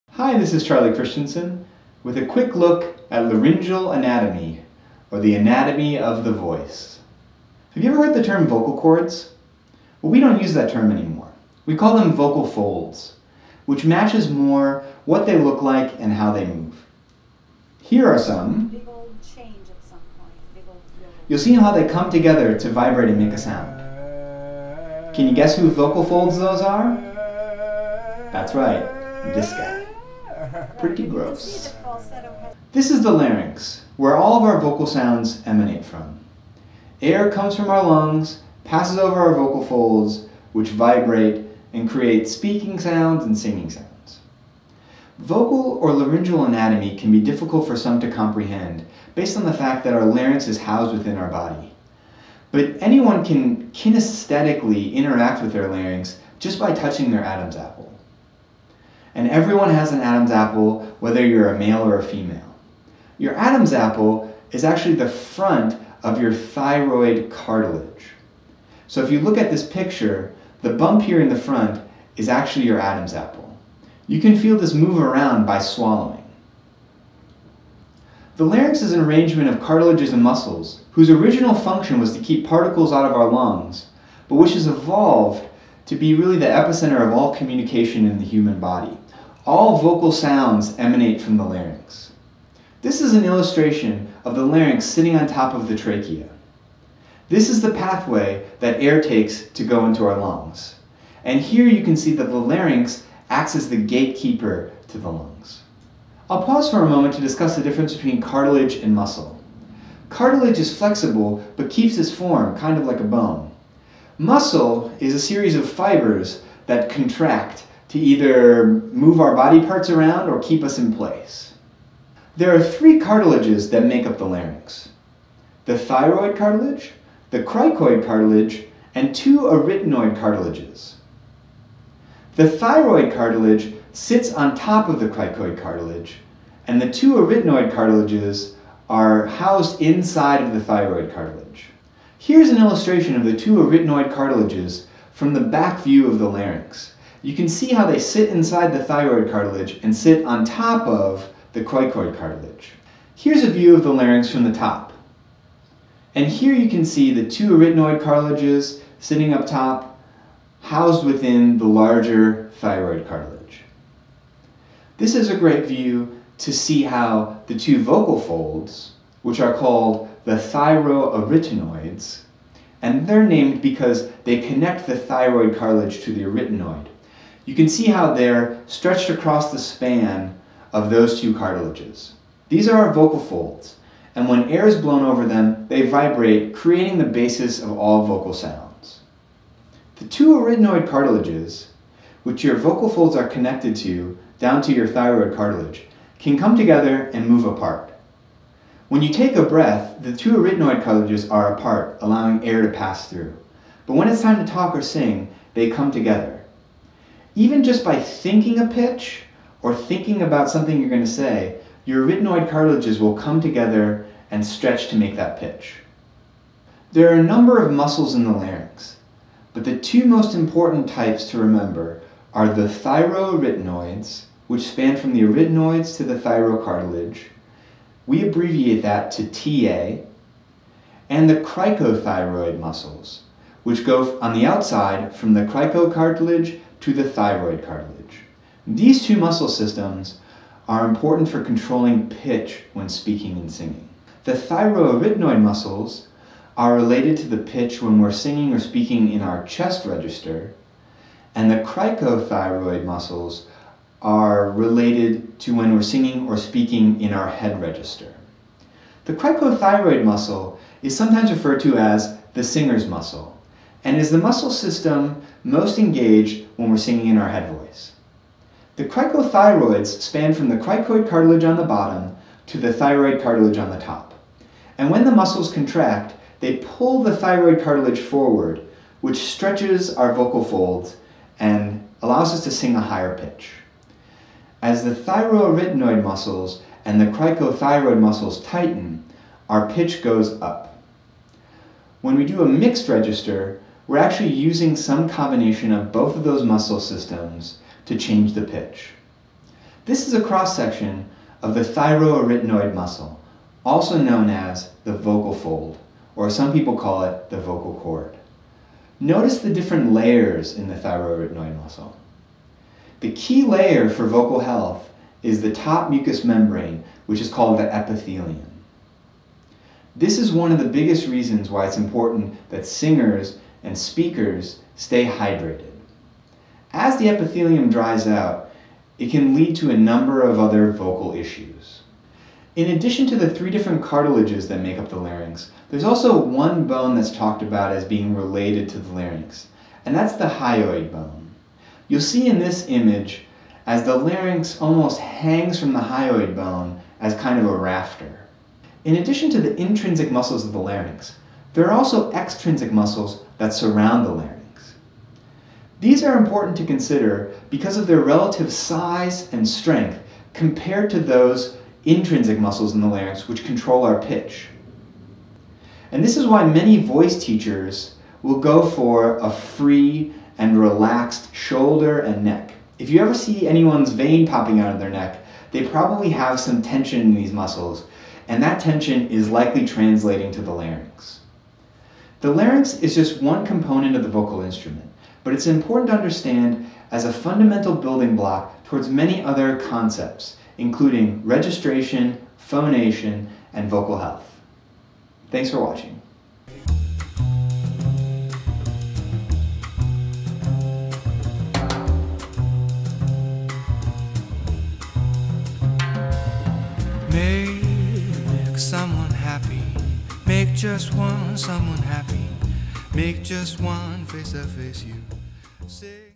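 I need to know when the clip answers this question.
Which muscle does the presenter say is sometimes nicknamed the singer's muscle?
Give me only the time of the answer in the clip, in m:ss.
4:19.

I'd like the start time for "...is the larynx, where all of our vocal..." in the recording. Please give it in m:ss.
0:32.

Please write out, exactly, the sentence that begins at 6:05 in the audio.
And this is why many voice teachers will go for a free and relaxed shoulder and neck.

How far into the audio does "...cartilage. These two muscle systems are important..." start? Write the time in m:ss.
3:57.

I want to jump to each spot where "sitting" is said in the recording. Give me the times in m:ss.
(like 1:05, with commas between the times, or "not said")
1:34, 2:38.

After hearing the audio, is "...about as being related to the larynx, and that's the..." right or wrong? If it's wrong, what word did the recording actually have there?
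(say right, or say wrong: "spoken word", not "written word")
right.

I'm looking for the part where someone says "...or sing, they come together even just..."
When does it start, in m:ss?
3:24.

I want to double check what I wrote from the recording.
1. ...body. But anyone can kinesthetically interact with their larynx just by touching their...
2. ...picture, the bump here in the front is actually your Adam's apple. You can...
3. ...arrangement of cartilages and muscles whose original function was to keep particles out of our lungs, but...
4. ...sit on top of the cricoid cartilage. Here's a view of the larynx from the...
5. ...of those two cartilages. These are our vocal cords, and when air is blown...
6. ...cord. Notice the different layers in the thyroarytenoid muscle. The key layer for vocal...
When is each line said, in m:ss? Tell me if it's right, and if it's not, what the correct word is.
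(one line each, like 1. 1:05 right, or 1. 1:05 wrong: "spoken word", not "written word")
1. 0:51 right
2. 1:09 right
3. 1:19 right
4. 2:29 right
5. 3:00 wrong: "folds", not "cords"
6. 5:07 right.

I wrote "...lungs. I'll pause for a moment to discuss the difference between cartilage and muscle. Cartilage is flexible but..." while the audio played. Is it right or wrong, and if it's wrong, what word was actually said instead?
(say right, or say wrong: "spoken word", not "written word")
right.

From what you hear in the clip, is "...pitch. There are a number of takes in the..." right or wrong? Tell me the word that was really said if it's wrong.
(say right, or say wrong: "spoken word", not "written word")
wrong: "muscles", not "takes".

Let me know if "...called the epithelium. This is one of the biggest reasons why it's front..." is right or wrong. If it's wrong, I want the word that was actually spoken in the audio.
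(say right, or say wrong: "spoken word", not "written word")
wrong: "important", not "front".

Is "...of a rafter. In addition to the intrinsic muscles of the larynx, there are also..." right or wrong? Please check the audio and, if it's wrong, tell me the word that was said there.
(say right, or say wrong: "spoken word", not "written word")
right.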